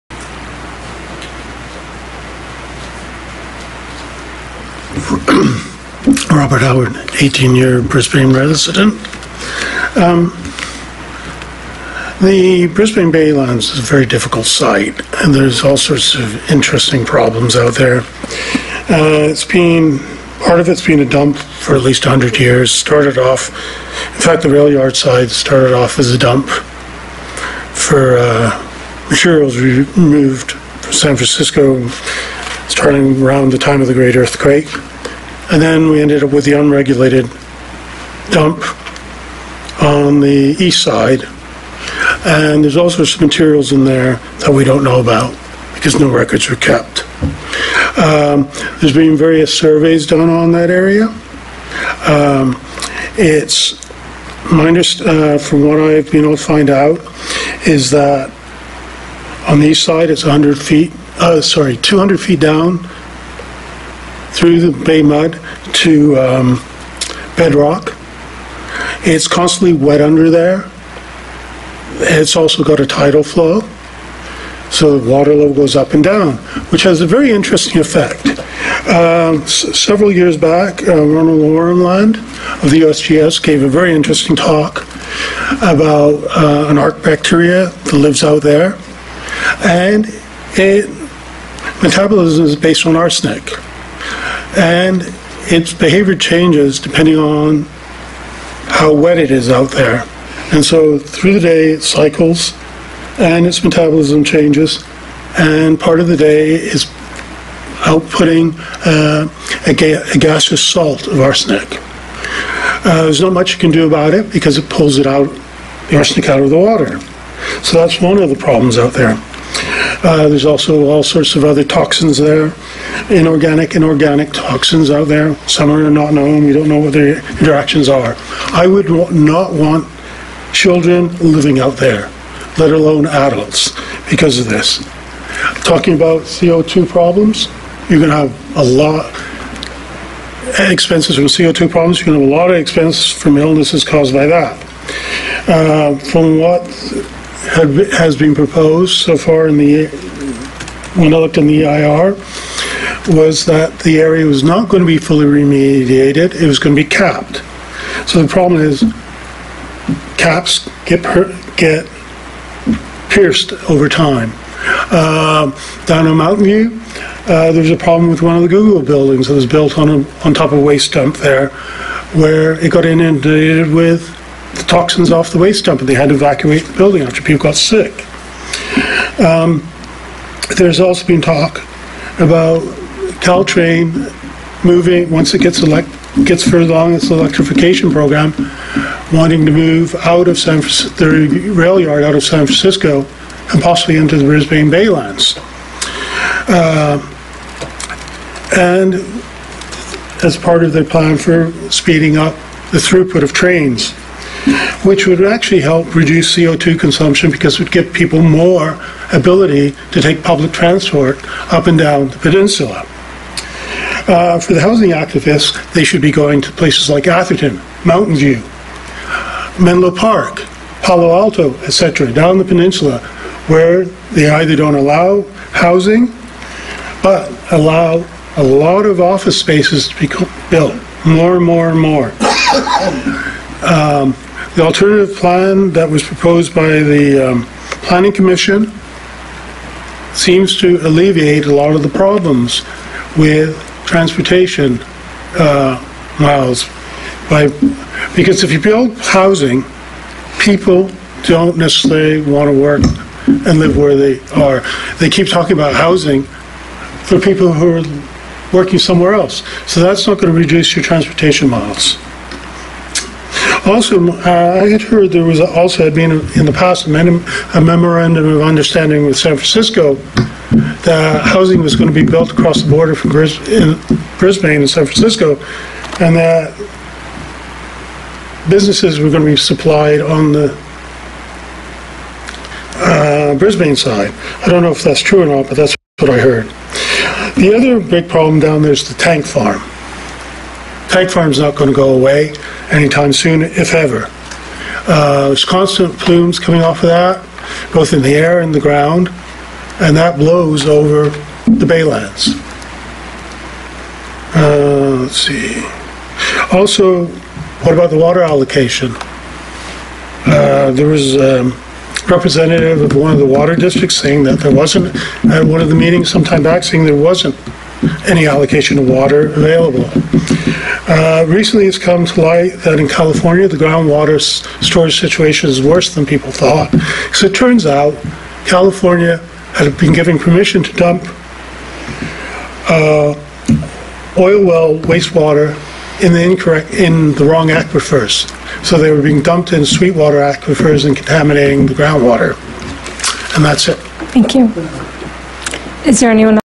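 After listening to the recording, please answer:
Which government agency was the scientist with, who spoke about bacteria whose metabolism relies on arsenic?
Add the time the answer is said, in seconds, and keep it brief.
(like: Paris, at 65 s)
USGS, at 82 s.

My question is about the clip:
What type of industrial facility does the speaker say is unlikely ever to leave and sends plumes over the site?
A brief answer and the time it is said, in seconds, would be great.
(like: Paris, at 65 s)
tank farm, at 288 s.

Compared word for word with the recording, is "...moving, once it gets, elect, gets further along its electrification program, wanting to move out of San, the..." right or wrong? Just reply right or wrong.
right.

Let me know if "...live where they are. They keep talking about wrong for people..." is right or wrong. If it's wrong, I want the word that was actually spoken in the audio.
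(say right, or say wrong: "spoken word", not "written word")
wrong: "housing", not "wrong".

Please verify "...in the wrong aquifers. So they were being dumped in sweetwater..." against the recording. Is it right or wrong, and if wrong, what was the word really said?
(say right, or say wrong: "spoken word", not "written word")
right.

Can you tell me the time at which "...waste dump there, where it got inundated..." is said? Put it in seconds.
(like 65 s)
170 s.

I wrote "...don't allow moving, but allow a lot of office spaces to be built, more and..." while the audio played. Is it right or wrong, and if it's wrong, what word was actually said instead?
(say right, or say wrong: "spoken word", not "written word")
wrong: "housing", not "moving".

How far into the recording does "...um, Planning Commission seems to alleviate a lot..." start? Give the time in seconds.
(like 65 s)
237 s.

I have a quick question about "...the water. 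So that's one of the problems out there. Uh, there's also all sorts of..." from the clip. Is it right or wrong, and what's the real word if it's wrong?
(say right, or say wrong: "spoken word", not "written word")
right.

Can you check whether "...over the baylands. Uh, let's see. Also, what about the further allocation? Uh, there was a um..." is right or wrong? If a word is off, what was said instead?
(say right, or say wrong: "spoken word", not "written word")
wrong: "water", not "further".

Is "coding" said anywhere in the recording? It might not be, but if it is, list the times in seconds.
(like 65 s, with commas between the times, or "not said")
not said.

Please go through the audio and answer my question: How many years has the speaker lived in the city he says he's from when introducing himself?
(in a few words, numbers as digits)
18.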